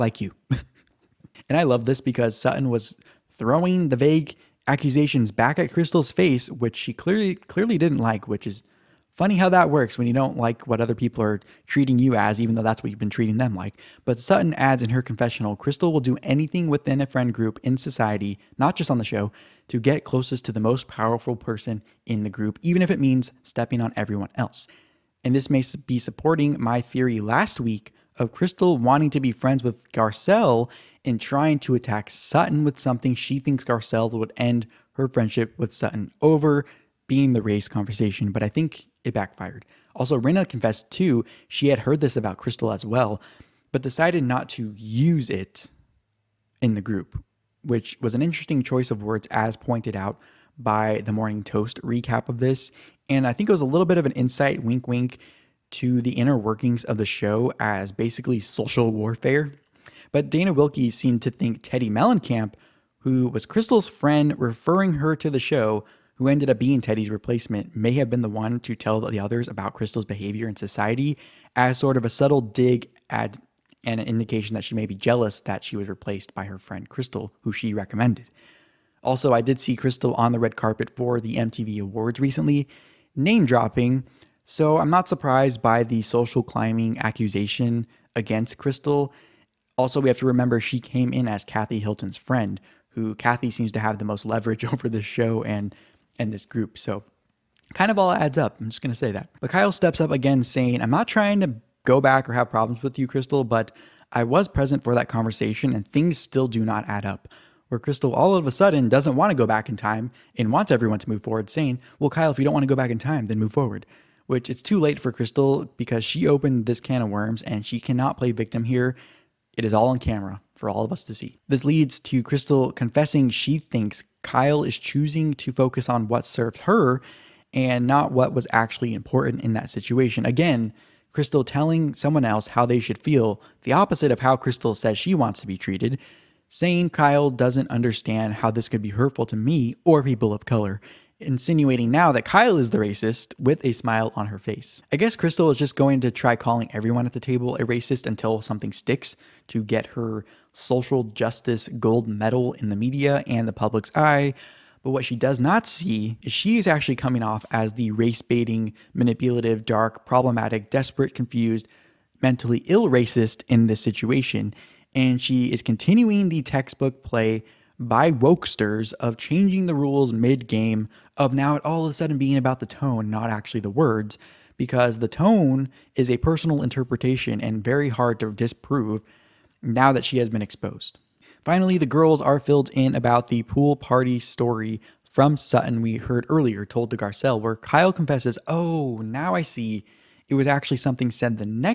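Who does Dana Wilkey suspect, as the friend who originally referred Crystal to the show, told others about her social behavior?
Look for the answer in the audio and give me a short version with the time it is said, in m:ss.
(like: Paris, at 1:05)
Teddi Mellencamp, at 1:01.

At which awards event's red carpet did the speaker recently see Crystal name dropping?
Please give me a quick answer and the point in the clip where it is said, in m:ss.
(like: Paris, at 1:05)
MTV Awards, at 1:21.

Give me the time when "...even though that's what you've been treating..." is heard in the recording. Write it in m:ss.
0:12.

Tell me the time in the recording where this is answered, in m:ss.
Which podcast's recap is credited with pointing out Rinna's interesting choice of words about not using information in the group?
0:51.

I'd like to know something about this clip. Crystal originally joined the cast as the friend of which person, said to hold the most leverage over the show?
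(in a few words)
Kathy Hilton.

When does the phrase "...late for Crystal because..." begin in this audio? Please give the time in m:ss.
1:54.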